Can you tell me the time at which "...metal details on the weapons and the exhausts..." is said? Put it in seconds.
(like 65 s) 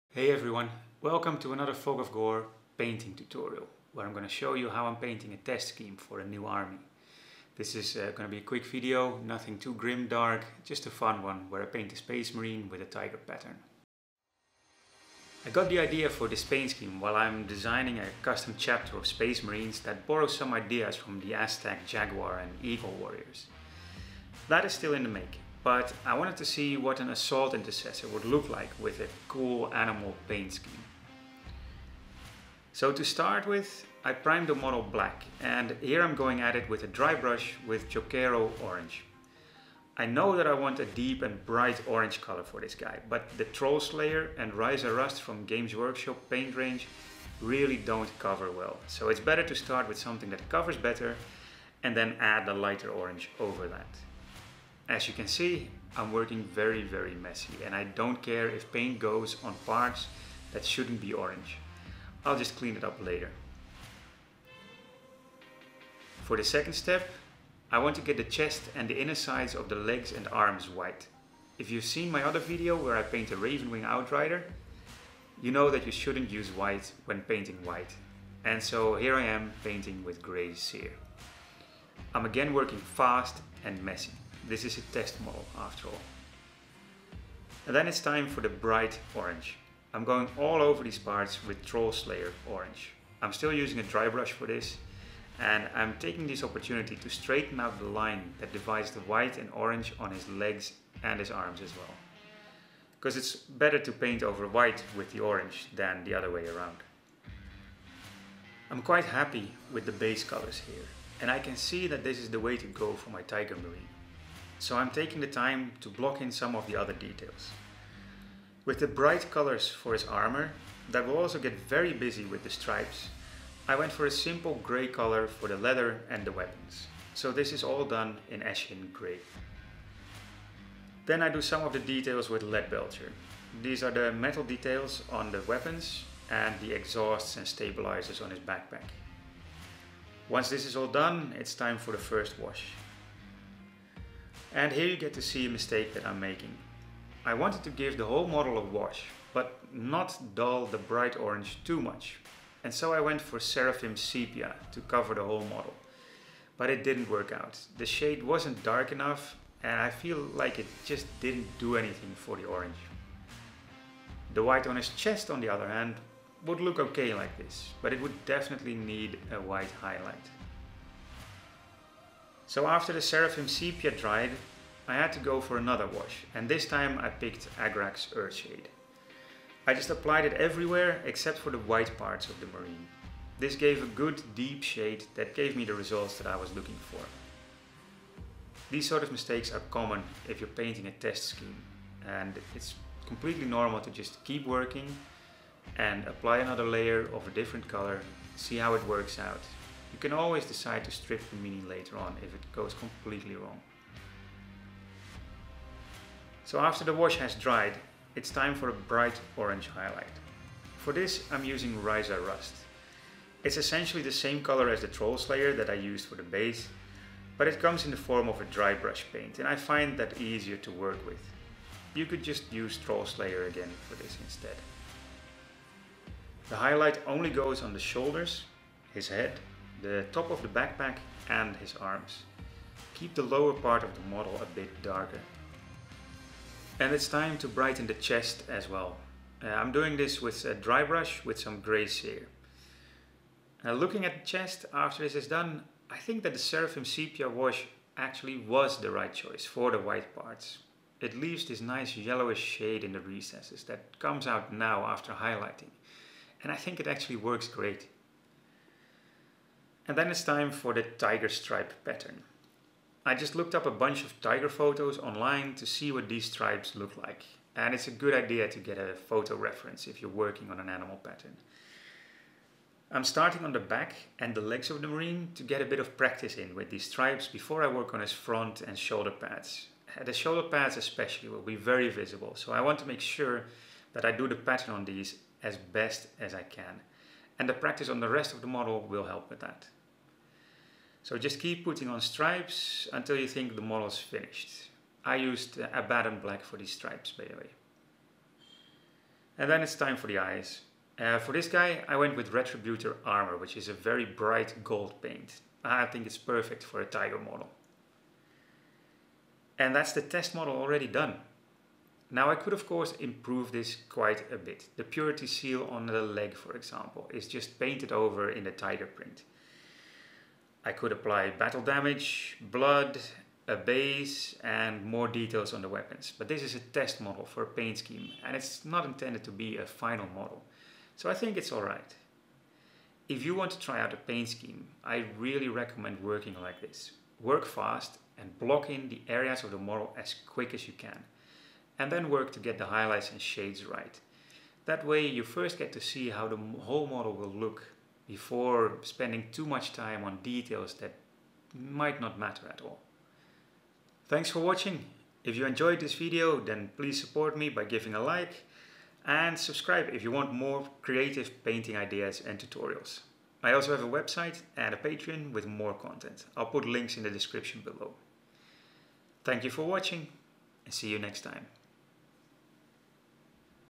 134 s.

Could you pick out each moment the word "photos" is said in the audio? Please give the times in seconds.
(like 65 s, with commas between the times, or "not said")
264 s, 268 s.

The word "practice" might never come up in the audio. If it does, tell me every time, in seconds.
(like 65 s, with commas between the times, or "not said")
275 s, 287 s.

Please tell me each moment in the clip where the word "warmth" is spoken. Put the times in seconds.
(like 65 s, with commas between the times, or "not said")
not said.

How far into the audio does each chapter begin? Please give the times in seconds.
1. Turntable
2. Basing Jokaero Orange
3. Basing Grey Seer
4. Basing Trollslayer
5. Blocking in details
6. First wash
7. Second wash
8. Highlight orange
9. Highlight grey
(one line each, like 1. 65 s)
1. 13 s
2. 32 s
3. 66 s
4. 87 s
5. 108 s
6. 140 s
7. 172 s
8. 206 s
9. 236 s.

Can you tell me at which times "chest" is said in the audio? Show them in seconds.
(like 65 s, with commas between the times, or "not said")
68 s, 164 s, 237 s, 244 s.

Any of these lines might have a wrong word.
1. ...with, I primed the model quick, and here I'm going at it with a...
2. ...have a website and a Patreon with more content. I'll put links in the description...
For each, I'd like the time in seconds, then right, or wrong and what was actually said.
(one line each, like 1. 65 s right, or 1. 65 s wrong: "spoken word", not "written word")
1. 33 s wrong: "black", not "quick"
2. 363 s right.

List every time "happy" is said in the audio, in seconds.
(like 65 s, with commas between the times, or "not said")
109 s.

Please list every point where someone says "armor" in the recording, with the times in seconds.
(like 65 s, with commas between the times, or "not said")
120 s, 303 s.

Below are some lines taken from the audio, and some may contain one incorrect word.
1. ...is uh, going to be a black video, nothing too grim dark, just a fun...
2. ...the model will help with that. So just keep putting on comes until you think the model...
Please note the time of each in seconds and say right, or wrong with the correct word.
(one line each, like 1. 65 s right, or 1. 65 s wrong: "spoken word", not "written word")
1. 7 s wrong: "quick", not "black"
2. 288 s wrong: "stripes", not "comes".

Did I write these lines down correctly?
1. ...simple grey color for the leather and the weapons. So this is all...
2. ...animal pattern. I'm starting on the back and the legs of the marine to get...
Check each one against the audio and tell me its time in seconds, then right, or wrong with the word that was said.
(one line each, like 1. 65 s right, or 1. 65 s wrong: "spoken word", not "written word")
1. 124 s right
2. 270 s right.